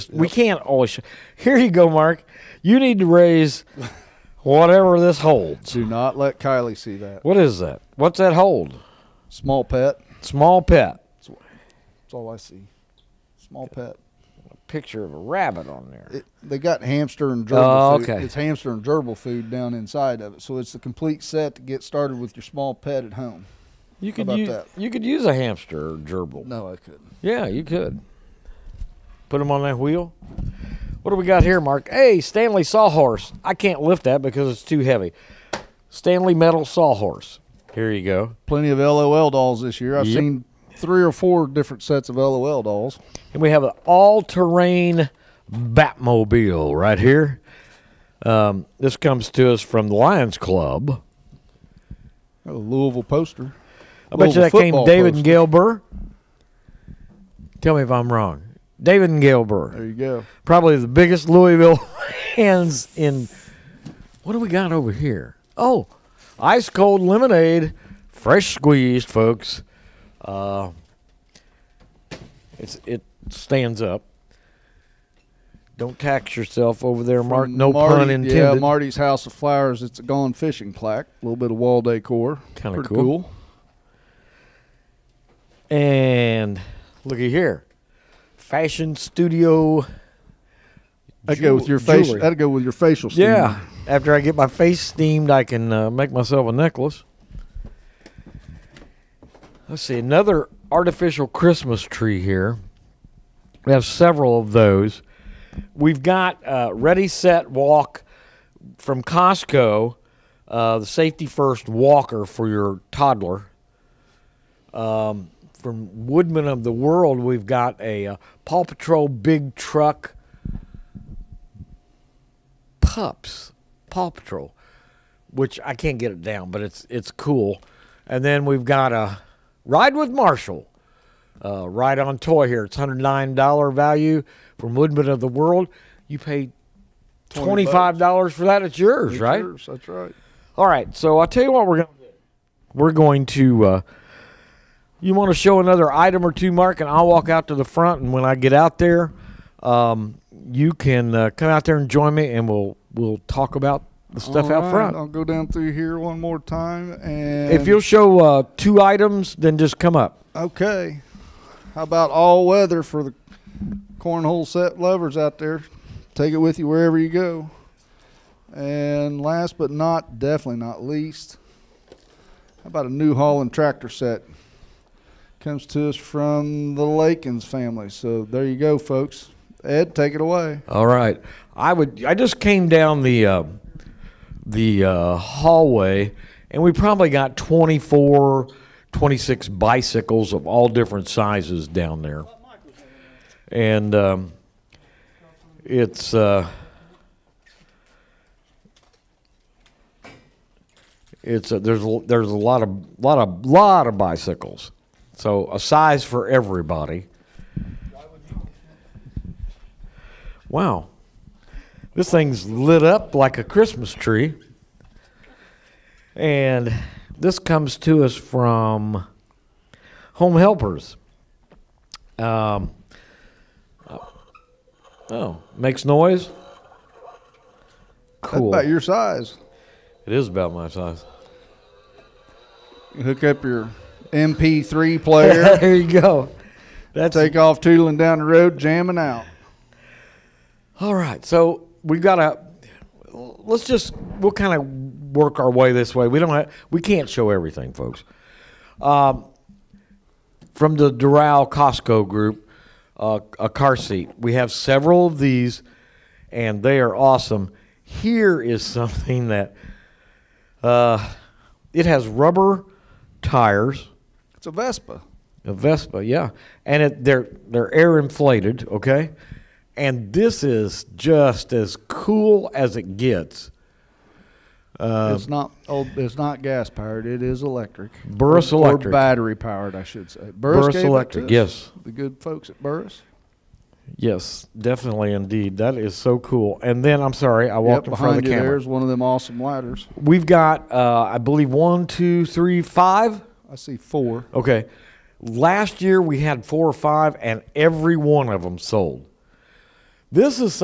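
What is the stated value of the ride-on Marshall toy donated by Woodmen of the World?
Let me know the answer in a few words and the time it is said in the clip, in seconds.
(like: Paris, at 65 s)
$109, at 132 s.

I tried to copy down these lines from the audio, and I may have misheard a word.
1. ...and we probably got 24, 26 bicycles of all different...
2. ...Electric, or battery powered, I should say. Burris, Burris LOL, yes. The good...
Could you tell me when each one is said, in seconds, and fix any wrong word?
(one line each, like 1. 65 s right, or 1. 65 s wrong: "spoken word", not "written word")
1. 186 s right
2. 278 s wrong: "Electric", not "LOL".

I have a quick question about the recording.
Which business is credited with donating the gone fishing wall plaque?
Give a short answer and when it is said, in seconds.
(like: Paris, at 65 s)
Marty's House of Flowers, at 78 s.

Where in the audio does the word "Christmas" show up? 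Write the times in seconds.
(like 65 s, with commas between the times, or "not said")
101 s, 213 s.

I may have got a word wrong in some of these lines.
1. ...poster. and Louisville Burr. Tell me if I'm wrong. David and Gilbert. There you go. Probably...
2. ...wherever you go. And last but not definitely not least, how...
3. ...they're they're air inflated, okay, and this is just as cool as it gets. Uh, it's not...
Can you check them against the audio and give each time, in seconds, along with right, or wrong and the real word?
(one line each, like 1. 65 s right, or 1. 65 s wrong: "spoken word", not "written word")
1. 55 s wrong: "Gail", not "Louisville"
2. 166 s right
3. 267 s right.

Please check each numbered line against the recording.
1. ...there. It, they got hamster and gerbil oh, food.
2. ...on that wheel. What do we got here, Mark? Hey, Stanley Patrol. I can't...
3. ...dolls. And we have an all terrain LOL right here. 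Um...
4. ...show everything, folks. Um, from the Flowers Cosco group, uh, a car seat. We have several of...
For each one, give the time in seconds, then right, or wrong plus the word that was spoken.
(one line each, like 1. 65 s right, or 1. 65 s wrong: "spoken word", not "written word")
1. 15 s right
2. 29 s wrong: "Sawhorse", not "Patrol"
3. 42 s wrong: "Batmobile", not "LOL"
4. 247 s wrong: "Dorel", not "Flowers".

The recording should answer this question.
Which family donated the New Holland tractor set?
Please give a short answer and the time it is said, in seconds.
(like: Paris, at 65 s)
Lakins, at 176 s.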